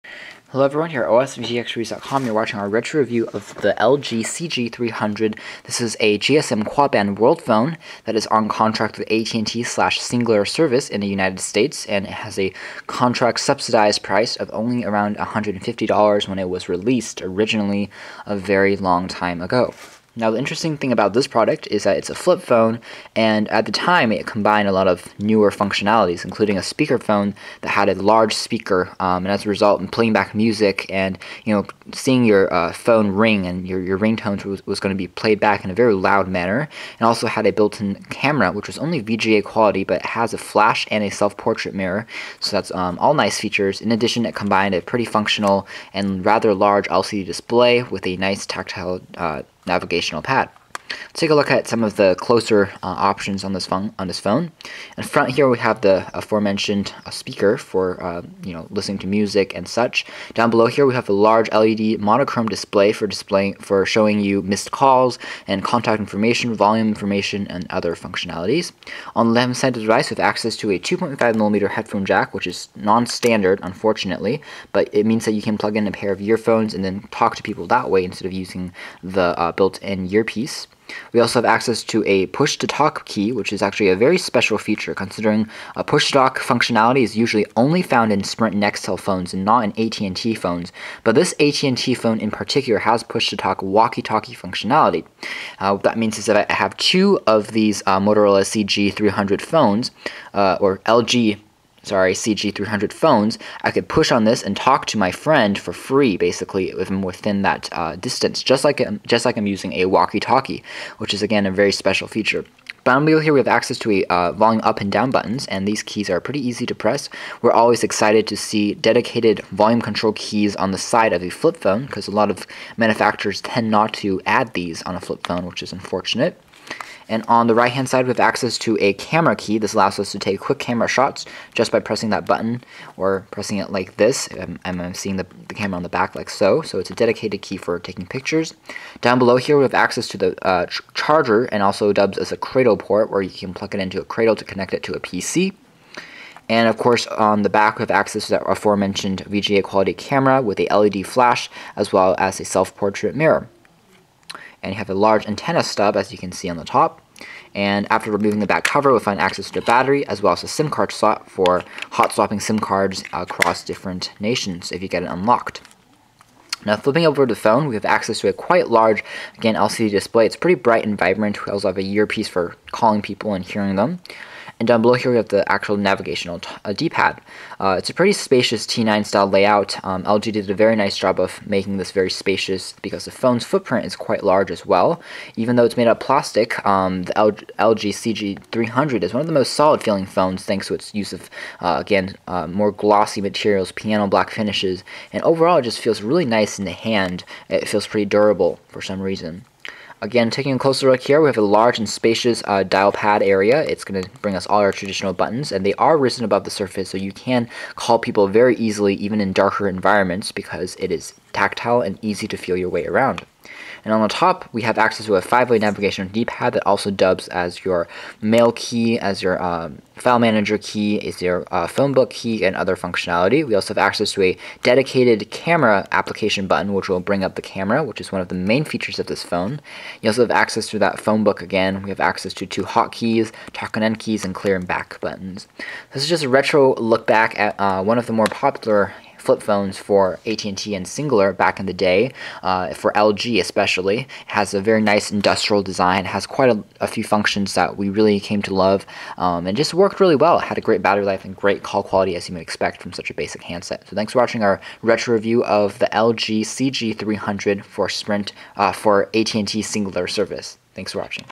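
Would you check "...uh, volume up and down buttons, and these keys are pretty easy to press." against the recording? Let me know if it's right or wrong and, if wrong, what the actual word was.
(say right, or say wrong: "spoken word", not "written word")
right.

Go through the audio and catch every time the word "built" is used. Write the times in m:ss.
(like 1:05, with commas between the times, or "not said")
0:37, 1:19.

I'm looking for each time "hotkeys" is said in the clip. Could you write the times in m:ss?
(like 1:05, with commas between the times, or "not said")
3:52.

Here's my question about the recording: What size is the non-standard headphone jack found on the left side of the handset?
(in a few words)
2.5 millimeter.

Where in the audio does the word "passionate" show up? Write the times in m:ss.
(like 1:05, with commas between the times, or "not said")
not said.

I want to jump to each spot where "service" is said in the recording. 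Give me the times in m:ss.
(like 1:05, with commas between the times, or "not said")
0:10, 4:20.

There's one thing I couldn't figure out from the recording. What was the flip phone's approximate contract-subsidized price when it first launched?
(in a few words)
$150.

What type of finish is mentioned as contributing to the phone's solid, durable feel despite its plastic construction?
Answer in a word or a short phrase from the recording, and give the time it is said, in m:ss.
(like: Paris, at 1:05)
Piano black, at 3:13.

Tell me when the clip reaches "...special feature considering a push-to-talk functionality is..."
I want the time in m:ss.
1:24.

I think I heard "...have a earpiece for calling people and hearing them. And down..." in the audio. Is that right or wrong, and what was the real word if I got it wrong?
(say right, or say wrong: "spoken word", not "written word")
right.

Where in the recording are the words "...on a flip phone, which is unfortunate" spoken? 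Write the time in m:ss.
2:04.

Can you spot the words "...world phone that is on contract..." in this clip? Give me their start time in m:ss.
0:07.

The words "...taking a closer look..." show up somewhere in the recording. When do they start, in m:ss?
3:20.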